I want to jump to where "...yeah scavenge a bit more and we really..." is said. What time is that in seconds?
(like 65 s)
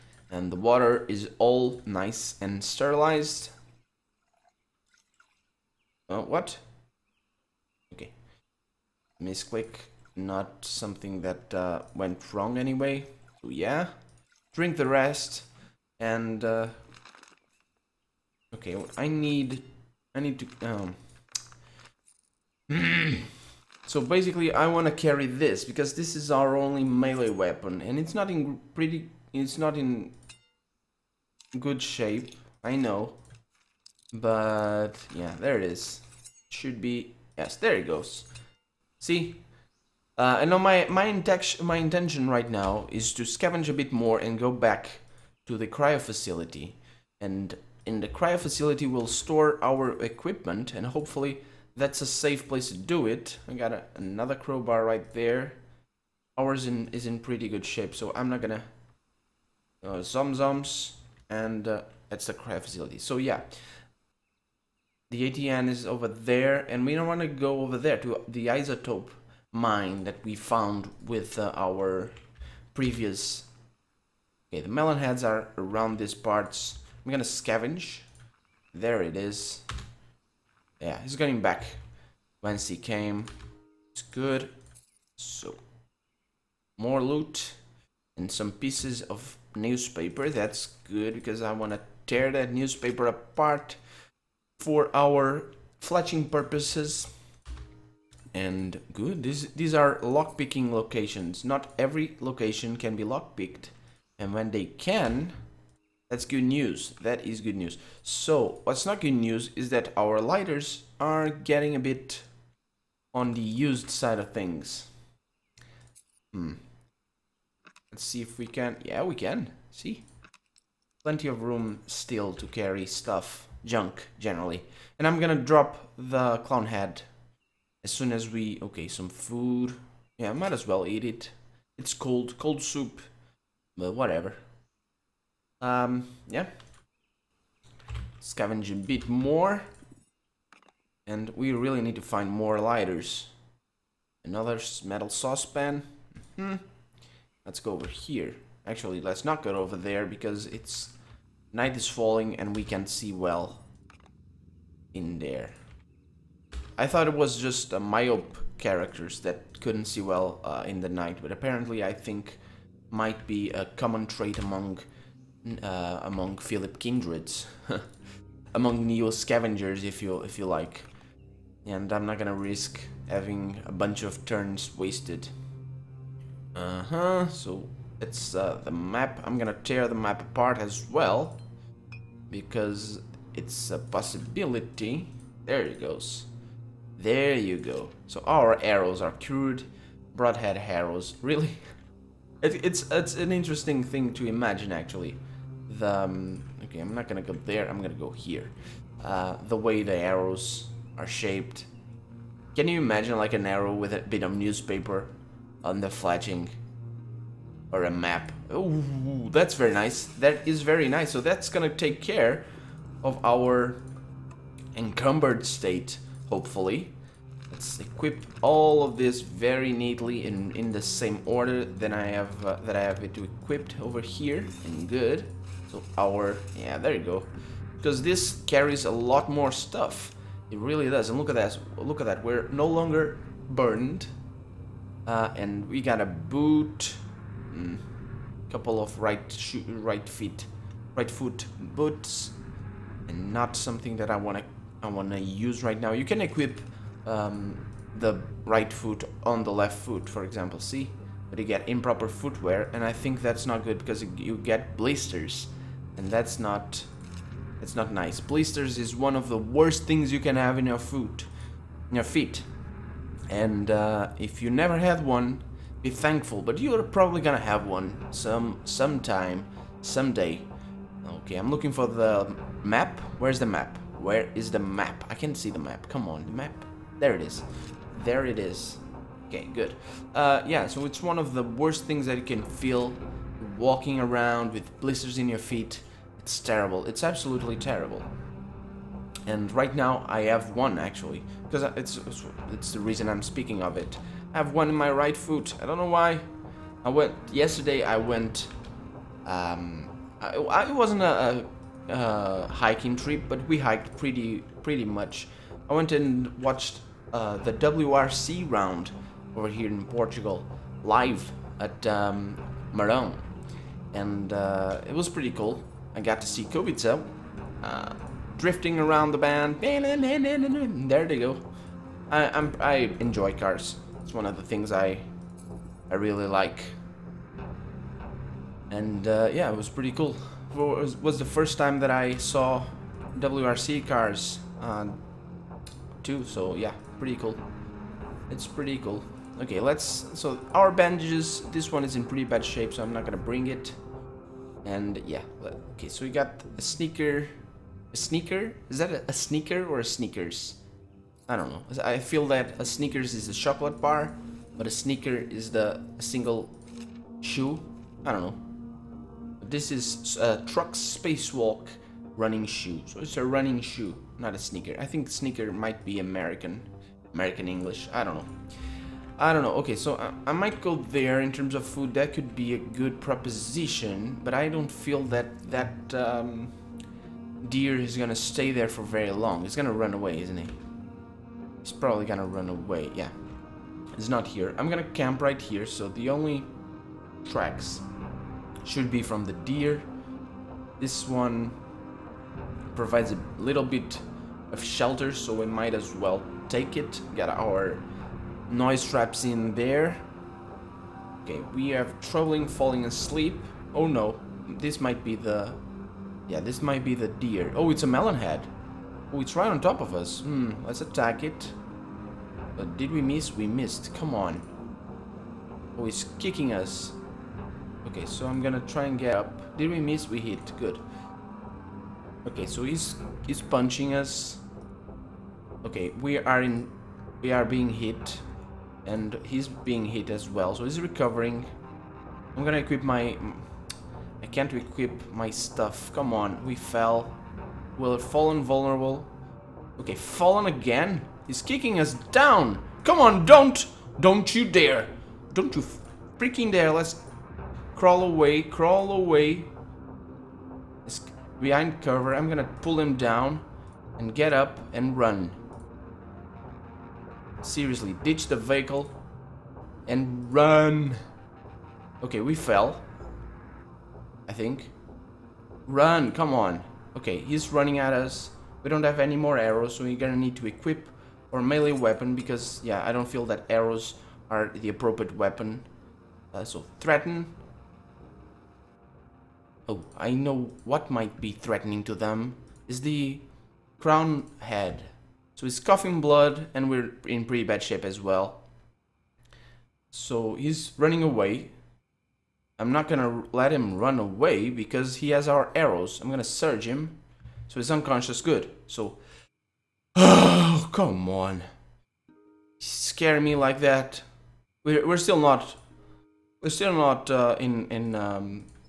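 136 s.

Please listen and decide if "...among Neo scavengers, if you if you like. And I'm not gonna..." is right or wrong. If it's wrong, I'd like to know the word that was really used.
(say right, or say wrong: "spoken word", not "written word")
right.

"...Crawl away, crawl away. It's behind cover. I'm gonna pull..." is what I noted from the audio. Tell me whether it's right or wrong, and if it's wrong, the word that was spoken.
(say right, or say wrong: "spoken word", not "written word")
right.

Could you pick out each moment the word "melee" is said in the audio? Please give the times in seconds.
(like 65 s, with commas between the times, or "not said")
26 s, 471 s.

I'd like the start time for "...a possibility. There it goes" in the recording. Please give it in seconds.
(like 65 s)
183 s.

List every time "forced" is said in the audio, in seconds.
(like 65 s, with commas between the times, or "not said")
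not said.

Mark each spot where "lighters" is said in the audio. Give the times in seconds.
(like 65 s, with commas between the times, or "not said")
110 s, 142 s.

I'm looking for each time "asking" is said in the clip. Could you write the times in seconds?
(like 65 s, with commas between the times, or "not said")
not said.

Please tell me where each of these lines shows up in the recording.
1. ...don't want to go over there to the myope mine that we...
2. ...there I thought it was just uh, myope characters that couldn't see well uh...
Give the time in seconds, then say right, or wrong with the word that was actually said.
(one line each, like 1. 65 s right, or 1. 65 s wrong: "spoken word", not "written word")
1. 66 s wrong: "isotope", not "myope"
2. 155 s right.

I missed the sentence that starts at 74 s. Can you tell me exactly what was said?
Okay, the melon heads are around these parts.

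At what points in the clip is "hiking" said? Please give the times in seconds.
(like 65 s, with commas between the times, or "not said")
302 s.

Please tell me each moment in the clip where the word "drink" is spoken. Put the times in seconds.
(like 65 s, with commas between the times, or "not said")
14 s.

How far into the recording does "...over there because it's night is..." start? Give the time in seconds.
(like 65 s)
149 s.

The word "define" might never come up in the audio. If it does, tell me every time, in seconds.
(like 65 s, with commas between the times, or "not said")
not said.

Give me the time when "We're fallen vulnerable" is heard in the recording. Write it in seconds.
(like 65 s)
437 s.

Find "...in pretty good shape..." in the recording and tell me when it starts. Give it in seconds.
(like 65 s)
57 s.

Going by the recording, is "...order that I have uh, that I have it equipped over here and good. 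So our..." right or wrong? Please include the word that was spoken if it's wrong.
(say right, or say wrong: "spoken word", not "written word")
right.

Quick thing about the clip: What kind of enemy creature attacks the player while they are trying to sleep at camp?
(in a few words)
A melon head.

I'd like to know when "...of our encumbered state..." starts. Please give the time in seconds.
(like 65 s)
213 s.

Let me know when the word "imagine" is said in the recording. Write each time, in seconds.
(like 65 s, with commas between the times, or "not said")
194 s, 202 s.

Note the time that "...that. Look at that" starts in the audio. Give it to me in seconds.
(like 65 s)
231 s.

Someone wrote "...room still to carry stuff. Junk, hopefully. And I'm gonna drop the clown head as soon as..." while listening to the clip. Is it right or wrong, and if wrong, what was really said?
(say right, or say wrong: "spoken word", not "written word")
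wrong: "generally", not "hopefully".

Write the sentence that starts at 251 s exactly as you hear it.
But you get improper footwear, and I think that's not good because you get blisters, and that's not, that's not nice.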